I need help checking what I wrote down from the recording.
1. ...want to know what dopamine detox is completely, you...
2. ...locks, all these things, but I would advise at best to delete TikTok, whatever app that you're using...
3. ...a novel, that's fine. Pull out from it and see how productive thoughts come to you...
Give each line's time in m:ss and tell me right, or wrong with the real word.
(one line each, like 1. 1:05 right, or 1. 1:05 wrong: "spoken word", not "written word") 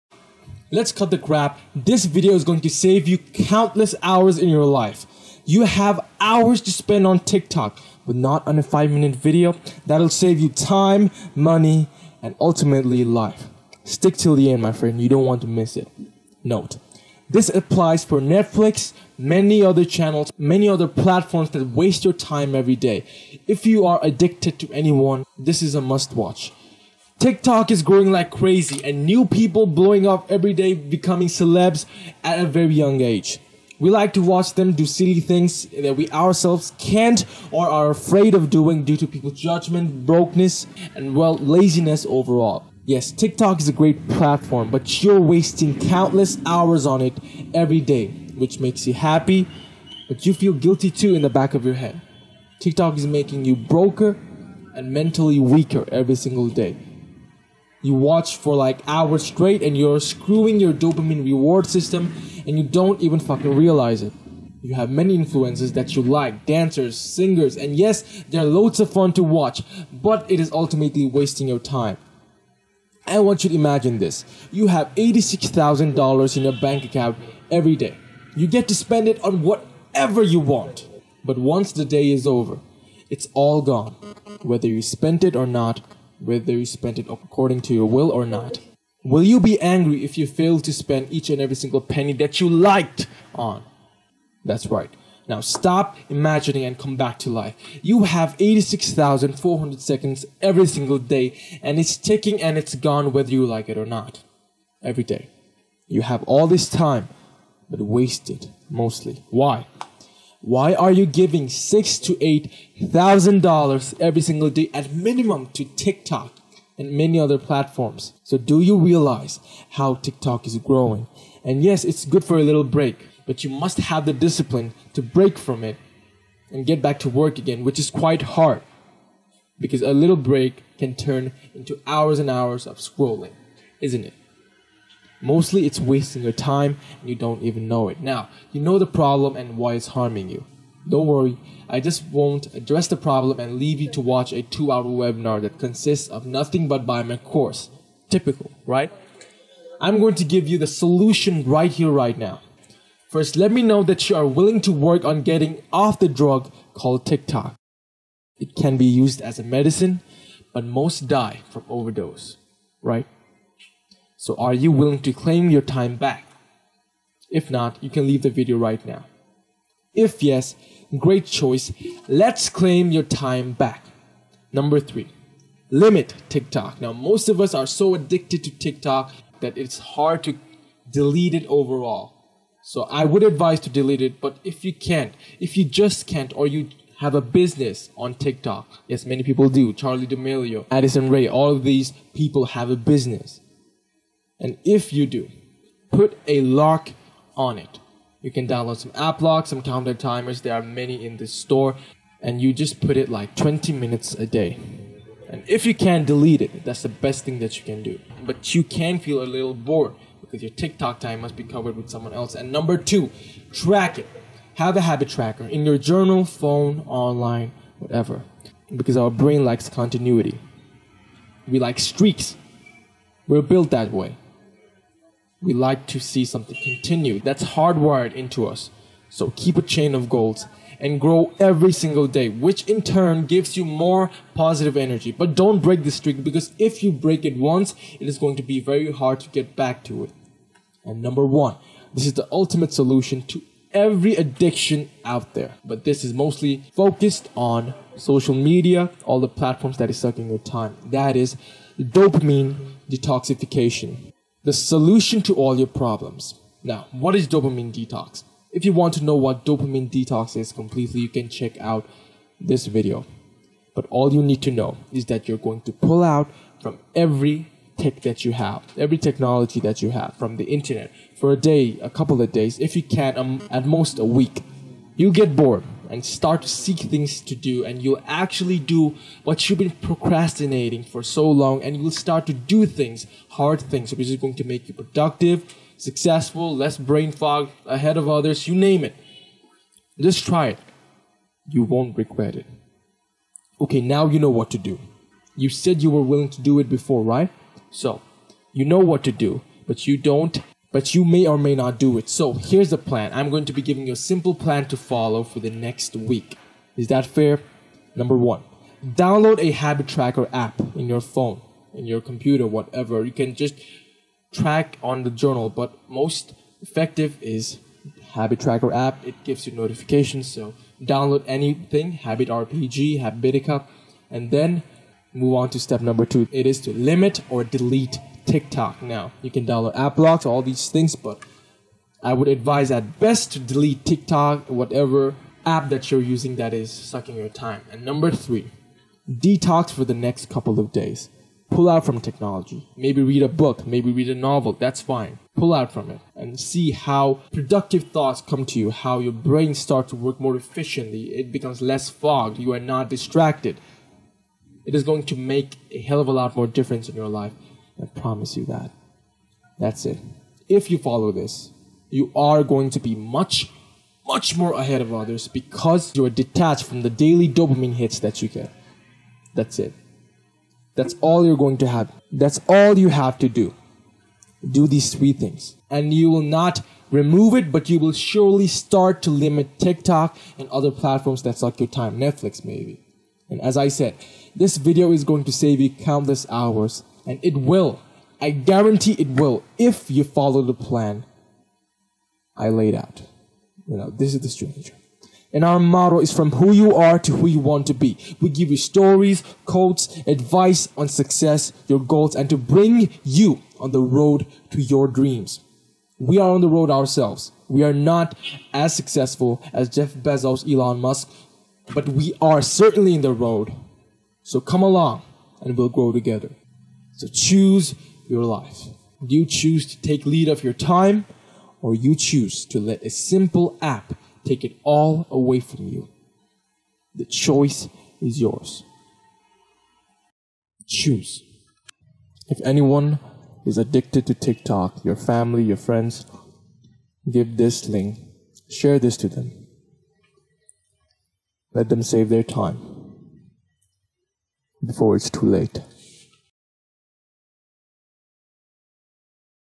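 1. 4:18 right
2. 5:29 wrong: "blocks", not "locks"
3. 5:44 right.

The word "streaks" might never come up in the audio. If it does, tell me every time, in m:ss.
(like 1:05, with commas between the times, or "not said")
3:41, 3:55.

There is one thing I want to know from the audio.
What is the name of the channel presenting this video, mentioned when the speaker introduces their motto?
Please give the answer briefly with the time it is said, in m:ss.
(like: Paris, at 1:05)
The Stranger, at 6:34.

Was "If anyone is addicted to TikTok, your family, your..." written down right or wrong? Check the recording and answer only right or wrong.
right.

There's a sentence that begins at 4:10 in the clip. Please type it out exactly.
That is dopamine detoxification the solution to all your problems.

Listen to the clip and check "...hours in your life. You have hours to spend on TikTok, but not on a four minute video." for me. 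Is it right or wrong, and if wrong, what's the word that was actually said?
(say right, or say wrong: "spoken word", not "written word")
wrong: "five", not "four".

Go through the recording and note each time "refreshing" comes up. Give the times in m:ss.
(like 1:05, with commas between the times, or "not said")
not said.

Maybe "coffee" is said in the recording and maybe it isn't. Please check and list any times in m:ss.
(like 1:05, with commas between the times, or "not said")
not said.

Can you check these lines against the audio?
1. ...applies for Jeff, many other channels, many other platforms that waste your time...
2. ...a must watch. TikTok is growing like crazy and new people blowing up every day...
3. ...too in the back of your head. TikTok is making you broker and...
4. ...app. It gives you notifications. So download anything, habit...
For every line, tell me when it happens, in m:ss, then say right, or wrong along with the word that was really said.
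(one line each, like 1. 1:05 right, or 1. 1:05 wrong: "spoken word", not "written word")
1. 0:17 wrong: "Netflix", not "Jeff"
2. 0:25 right
3. 0:50 right
4. 5:18 right.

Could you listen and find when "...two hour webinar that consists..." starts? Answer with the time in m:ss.
2:24.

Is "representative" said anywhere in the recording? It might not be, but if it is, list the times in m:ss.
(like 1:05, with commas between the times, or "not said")
not said.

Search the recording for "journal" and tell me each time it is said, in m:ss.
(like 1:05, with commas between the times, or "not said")
3:35, 5:15.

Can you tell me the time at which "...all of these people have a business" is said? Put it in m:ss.
3:11.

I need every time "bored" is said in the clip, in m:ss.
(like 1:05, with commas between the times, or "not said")
3:29, 4:35.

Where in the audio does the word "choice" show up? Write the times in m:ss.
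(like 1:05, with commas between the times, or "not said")
2:51, 7:07.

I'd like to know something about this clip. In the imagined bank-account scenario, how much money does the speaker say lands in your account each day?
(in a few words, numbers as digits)
$86,000.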